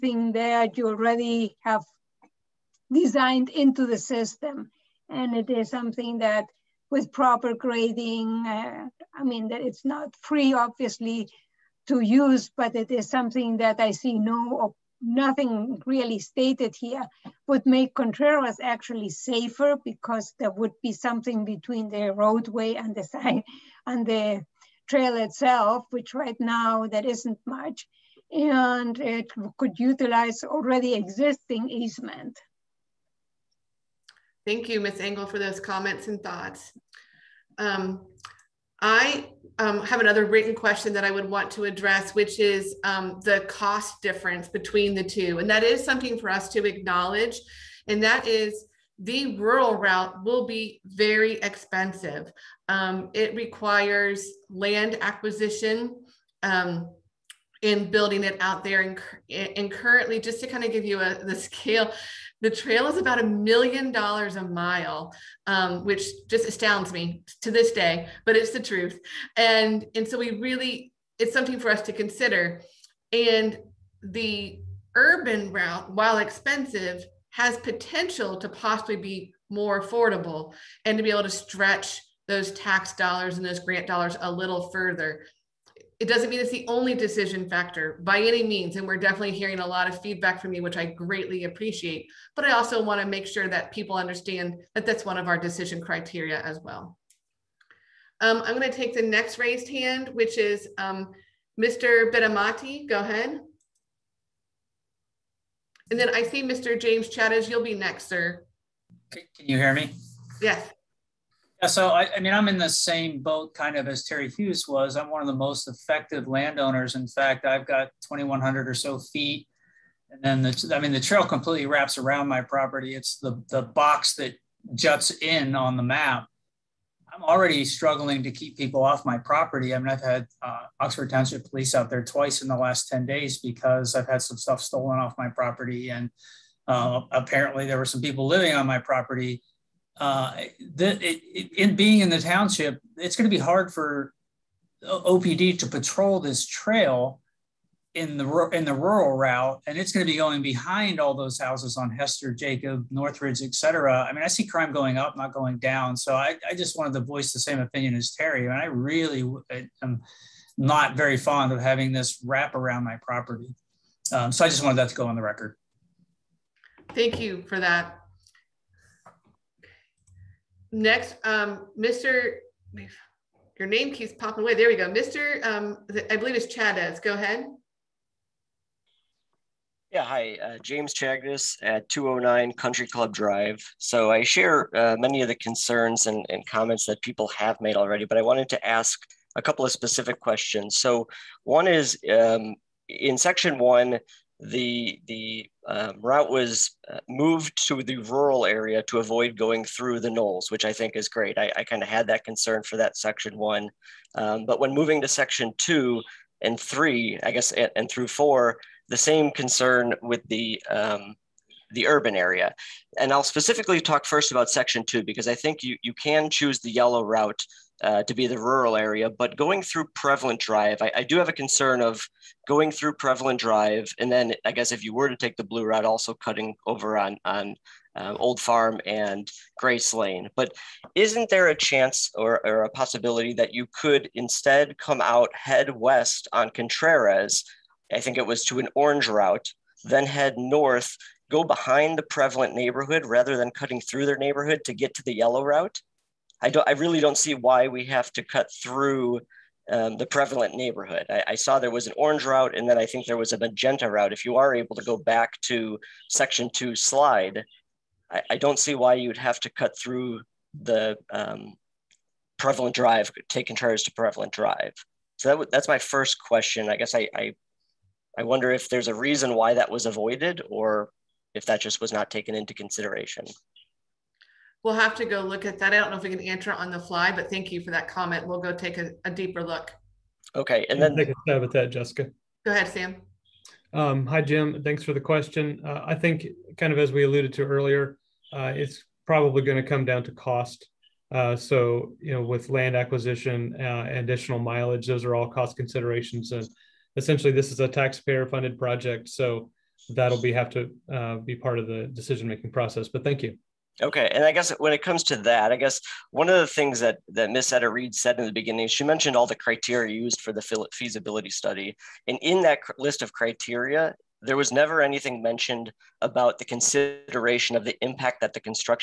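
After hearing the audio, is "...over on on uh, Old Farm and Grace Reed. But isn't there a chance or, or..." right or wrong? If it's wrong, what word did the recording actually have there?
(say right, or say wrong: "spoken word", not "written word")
wrong: "Lane", not "Reed".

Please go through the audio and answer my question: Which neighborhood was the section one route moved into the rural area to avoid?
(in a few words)
the Knolls.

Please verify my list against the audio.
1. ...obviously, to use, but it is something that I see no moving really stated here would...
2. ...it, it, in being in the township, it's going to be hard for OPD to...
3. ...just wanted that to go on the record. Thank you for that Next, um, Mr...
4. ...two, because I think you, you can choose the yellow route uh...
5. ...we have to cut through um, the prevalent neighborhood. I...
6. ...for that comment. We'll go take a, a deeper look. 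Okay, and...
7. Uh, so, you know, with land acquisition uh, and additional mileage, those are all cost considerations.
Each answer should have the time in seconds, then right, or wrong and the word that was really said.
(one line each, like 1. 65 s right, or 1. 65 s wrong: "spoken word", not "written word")
1. 10 s wrong: "nothing", not "moving"
2. 141 s right
3. 164 s right
4. 214 s right
5. 247 s right
6. 277 s right
7. 291 s right.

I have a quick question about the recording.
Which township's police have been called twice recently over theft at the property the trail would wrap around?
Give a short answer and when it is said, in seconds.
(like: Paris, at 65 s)
Oxford Township, at 130 s.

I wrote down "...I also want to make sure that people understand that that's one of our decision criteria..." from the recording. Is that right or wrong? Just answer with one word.
right.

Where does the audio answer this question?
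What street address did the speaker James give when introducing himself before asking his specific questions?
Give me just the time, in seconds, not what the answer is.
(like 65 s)
181 s.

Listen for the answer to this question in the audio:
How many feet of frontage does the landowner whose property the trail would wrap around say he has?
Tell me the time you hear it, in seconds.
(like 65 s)
118 s.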